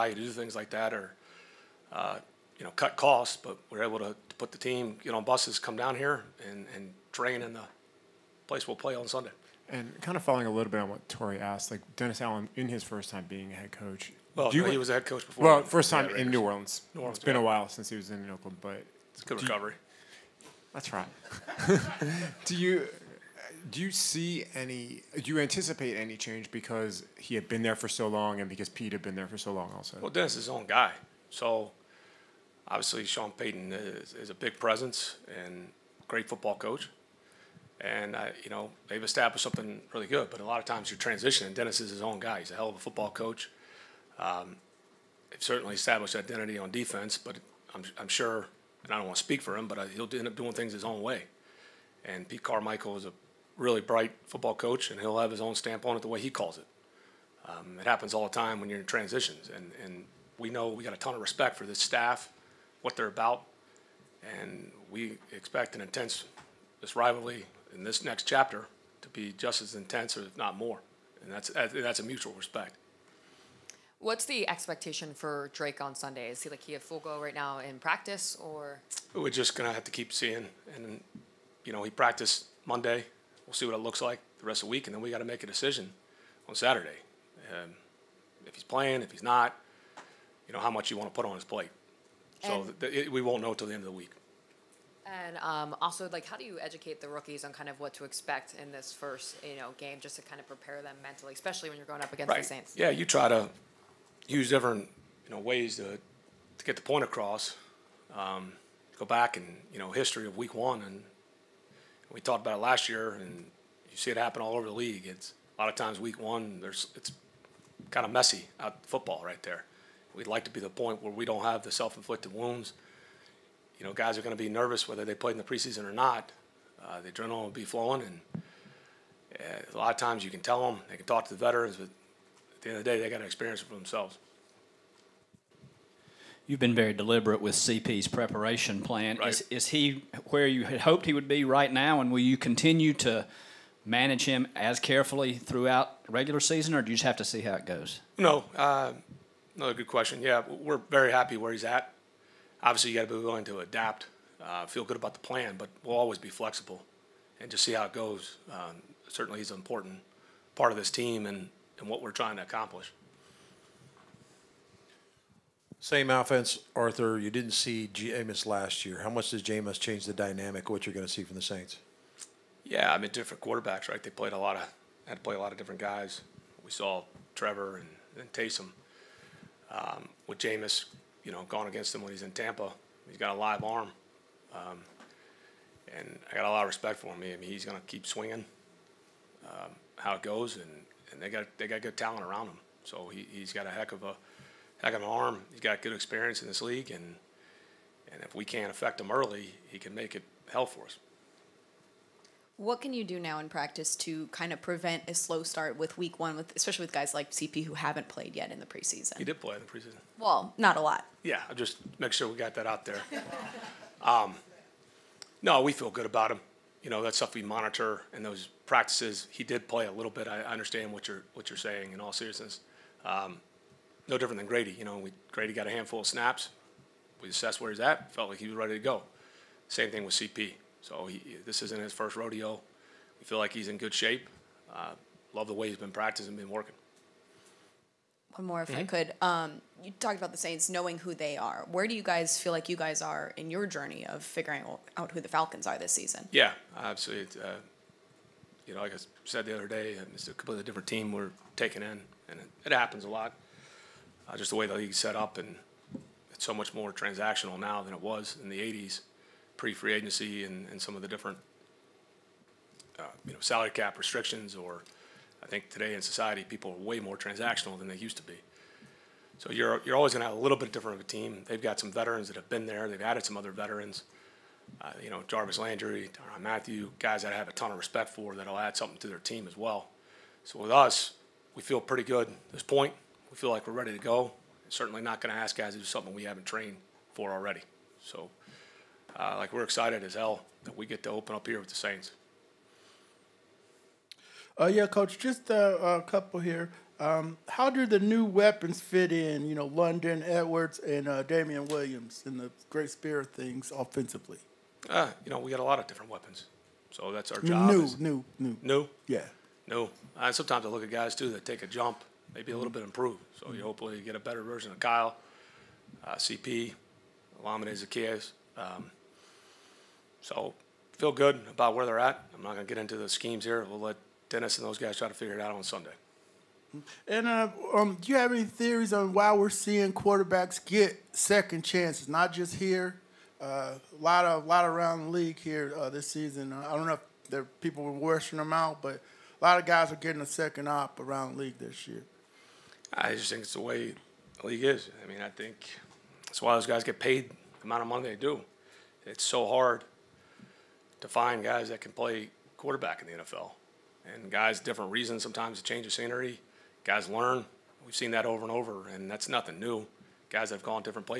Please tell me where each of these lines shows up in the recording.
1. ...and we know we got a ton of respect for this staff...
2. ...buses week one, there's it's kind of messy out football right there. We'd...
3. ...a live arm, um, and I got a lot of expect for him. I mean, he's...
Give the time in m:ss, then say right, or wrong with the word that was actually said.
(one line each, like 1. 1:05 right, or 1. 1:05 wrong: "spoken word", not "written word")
1. 0:59 right
2. 1:55 wrong: "times", not "buses"
3. 3:03 wrong: "respect", not "expect".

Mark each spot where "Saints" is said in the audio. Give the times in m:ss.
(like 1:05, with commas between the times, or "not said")
1:42, 2:51, 4:00, 4:51.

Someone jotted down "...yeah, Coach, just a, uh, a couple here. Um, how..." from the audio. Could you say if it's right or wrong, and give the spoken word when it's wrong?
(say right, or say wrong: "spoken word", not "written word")
right.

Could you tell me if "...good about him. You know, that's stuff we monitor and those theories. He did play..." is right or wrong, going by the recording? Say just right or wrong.
wrong.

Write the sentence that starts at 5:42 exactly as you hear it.
I just think it's the way the league is.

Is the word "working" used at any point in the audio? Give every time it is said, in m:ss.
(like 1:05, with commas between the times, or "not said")
3:56.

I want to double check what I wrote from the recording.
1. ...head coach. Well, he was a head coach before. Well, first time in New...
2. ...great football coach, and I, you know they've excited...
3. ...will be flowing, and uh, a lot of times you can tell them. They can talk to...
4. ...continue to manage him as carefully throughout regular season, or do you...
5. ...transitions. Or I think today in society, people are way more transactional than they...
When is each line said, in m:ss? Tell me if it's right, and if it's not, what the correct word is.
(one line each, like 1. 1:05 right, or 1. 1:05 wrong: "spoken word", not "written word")
1. 0:13 right
2. 0:36 wrong: "established", not "excited"
3. 2:07 right
4. 2:22 right
5. 4:23 wrong: "restrictions", not "transitions".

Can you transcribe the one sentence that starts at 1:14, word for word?
What's the expectation for Drake on Sunday?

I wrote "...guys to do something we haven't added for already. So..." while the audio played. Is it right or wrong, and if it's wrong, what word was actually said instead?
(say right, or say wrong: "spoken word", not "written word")
wrong: "trained", not "added".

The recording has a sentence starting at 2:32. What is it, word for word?
Obviously, you got to be willing to adapt.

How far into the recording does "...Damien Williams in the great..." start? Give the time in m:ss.
5:01.